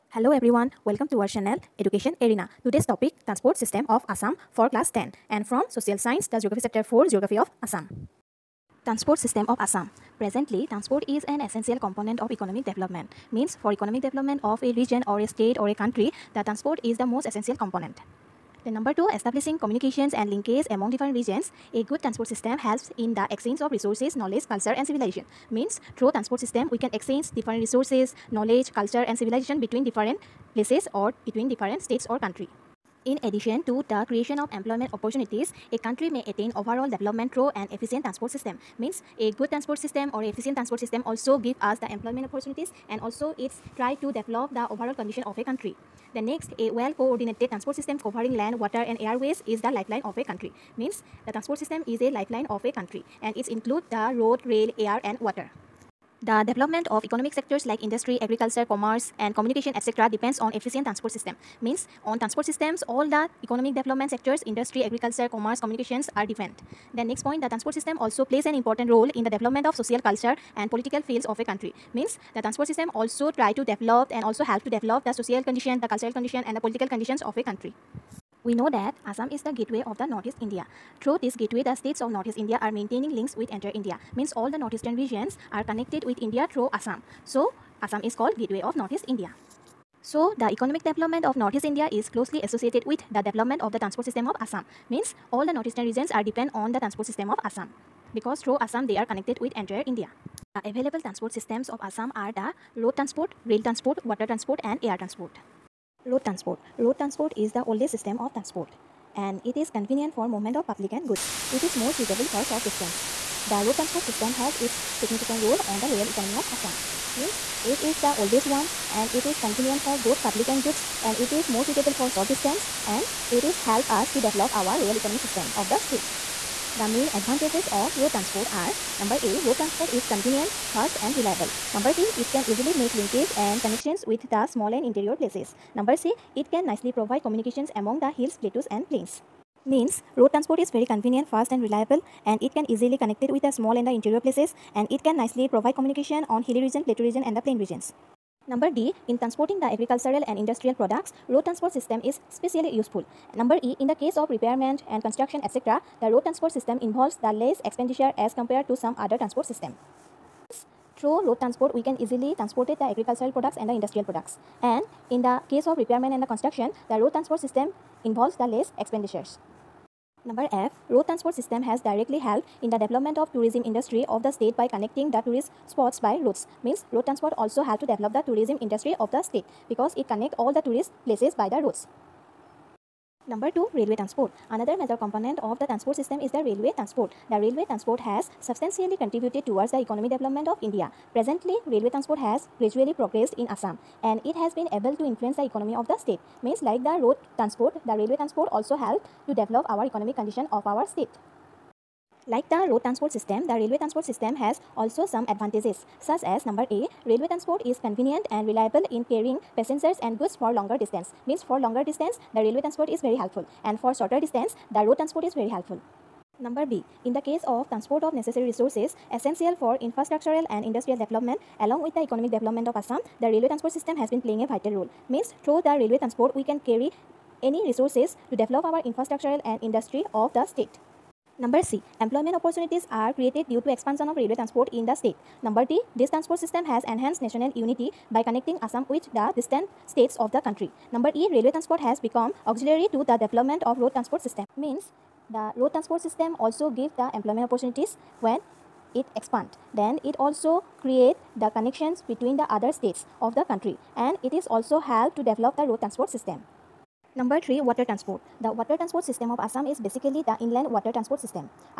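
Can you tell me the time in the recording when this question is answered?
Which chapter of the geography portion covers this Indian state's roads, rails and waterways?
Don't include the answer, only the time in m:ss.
0:06.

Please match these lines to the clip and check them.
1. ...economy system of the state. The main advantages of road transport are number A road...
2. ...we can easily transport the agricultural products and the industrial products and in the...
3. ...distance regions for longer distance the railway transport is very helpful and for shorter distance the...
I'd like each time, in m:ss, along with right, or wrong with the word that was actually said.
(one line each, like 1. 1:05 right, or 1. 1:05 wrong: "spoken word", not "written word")
1. 2:04 right
2. 2:41 right
3. 3:30 wrong: "means", not "regions".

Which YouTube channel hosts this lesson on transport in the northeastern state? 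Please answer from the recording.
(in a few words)
Education Arena.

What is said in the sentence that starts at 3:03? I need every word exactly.
Number 2 Railway Transport Another major component of the transport system is the railway transport.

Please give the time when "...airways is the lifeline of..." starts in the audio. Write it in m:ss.
0:48.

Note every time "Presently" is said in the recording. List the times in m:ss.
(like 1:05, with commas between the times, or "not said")
0:10, 3:11.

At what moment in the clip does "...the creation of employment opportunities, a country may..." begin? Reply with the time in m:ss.
0:33.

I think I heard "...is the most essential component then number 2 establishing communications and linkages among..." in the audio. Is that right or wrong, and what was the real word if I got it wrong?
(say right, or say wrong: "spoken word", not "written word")
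right.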